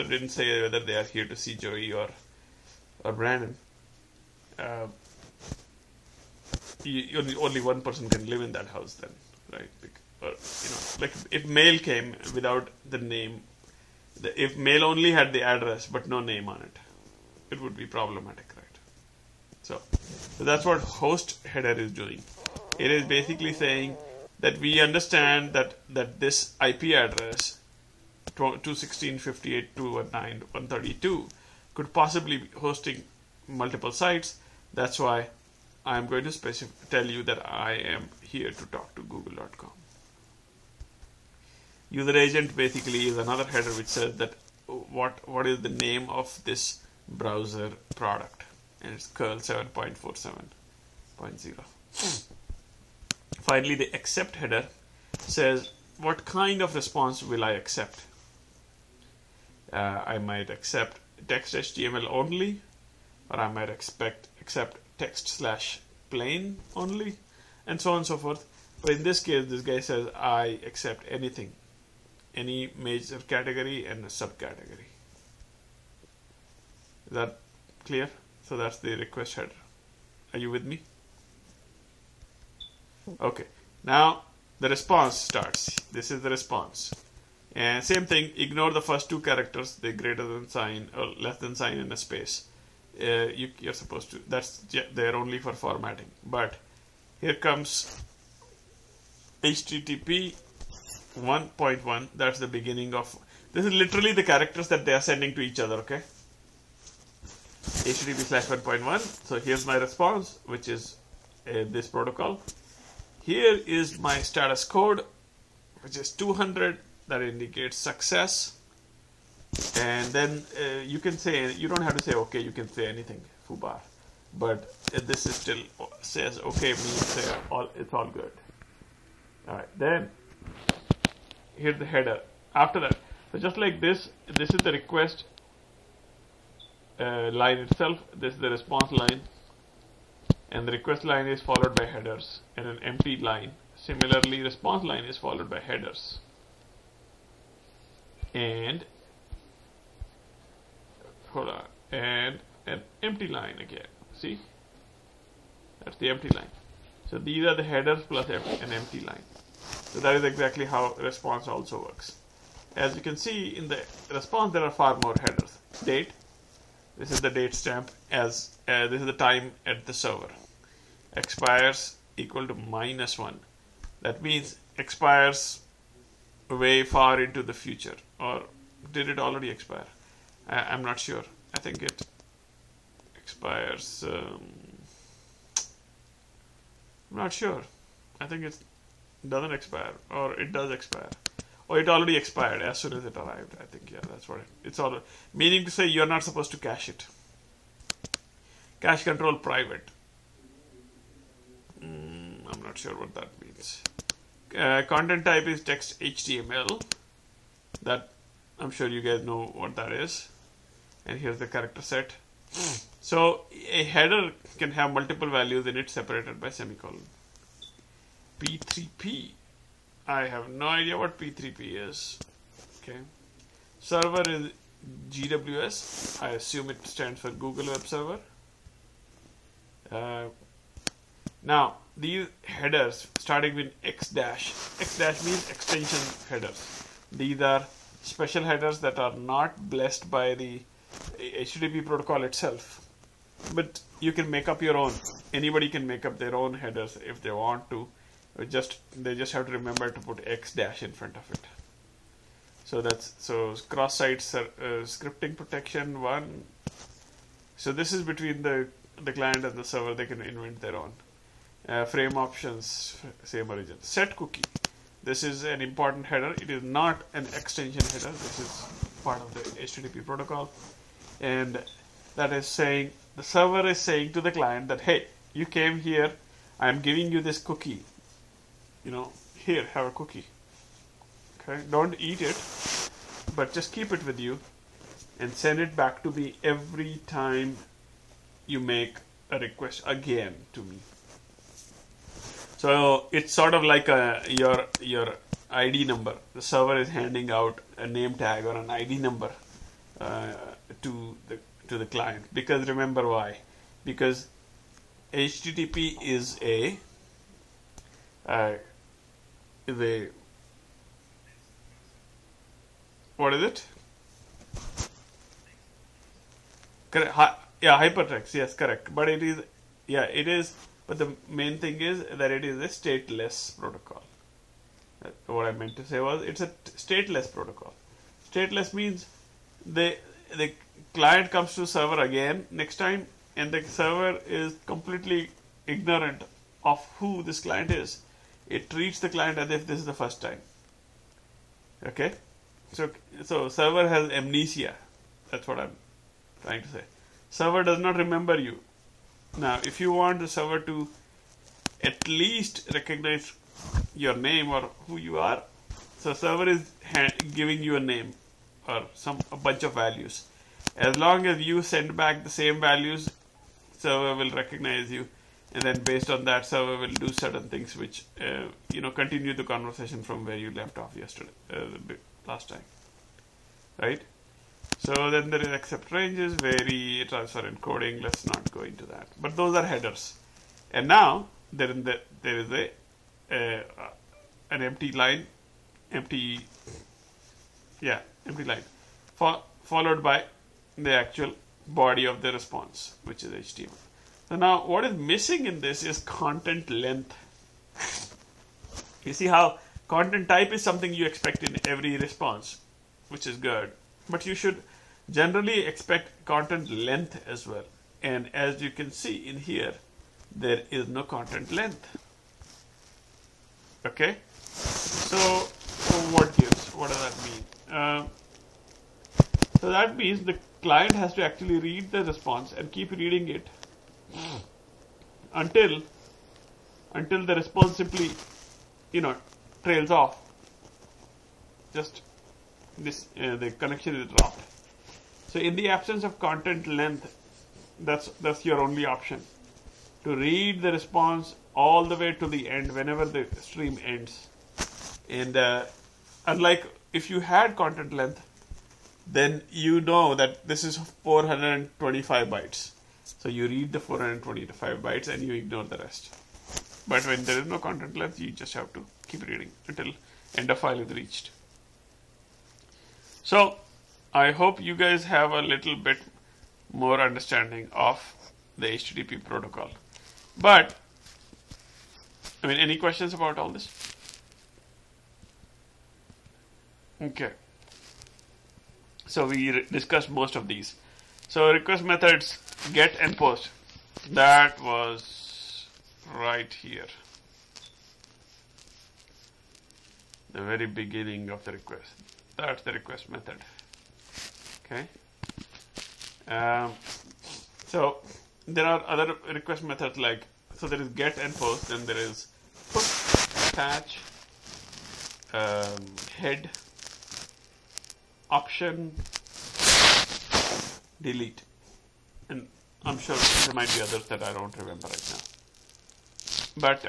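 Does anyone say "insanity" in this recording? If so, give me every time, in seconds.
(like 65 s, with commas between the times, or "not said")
not said.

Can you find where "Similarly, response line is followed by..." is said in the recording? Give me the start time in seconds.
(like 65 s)
143 s.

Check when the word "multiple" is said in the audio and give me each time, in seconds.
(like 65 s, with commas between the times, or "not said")
33 s, 214 s.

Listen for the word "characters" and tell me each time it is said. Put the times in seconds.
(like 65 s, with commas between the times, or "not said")
89 s, 104 s, 211 s.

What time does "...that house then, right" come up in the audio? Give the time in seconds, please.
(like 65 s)
8 s.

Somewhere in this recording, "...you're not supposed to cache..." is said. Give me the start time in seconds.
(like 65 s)
195 s.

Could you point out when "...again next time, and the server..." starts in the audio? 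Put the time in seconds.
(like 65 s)
332 s.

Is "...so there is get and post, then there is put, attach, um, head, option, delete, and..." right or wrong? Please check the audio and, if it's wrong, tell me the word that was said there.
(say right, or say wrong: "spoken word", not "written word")
right.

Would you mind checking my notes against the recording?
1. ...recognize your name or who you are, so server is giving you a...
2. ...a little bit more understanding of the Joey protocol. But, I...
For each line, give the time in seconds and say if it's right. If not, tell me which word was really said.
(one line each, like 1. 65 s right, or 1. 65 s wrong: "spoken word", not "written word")
1. 352 s right
2. 465 s wrong: "HTTP", not "Joey".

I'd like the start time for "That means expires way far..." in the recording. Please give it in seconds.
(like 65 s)
174 s.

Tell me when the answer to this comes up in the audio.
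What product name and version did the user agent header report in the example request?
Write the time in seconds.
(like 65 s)
49 s.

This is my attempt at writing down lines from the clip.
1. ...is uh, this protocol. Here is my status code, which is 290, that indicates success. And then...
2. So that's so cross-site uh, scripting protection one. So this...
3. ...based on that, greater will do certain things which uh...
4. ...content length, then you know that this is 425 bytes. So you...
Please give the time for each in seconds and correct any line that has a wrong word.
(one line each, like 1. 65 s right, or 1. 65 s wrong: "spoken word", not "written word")
1. 110 s wrong: "200", not "290"
2. 252 s right
3. 365 s wrong: "server", not "greater"
4. 447 s right.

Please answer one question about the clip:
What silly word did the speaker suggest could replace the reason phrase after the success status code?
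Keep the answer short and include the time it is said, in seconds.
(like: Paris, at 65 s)
fubar, at 123 s.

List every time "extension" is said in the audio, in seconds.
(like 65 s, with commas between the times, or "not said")
235 s, 267 s.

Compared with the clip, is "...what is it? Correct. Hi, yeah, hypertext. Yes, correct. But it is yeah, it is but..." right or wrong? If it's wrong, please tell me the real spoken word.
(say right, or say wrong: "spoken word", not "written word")
right.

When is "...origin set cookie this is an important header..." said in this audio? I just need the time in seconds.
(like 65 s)
263 s.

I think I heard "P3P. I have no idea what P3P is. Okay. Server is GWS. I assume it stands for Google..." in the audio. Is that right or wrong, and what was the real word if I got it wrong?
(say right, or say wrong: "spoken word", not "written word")
right.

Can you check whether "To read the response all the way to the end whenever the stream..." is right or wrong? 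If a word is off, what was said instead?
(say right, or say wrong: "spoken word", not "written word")
right.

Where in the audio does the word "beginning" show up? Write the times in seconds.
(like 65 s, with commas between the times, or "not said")
102 s, 490 s.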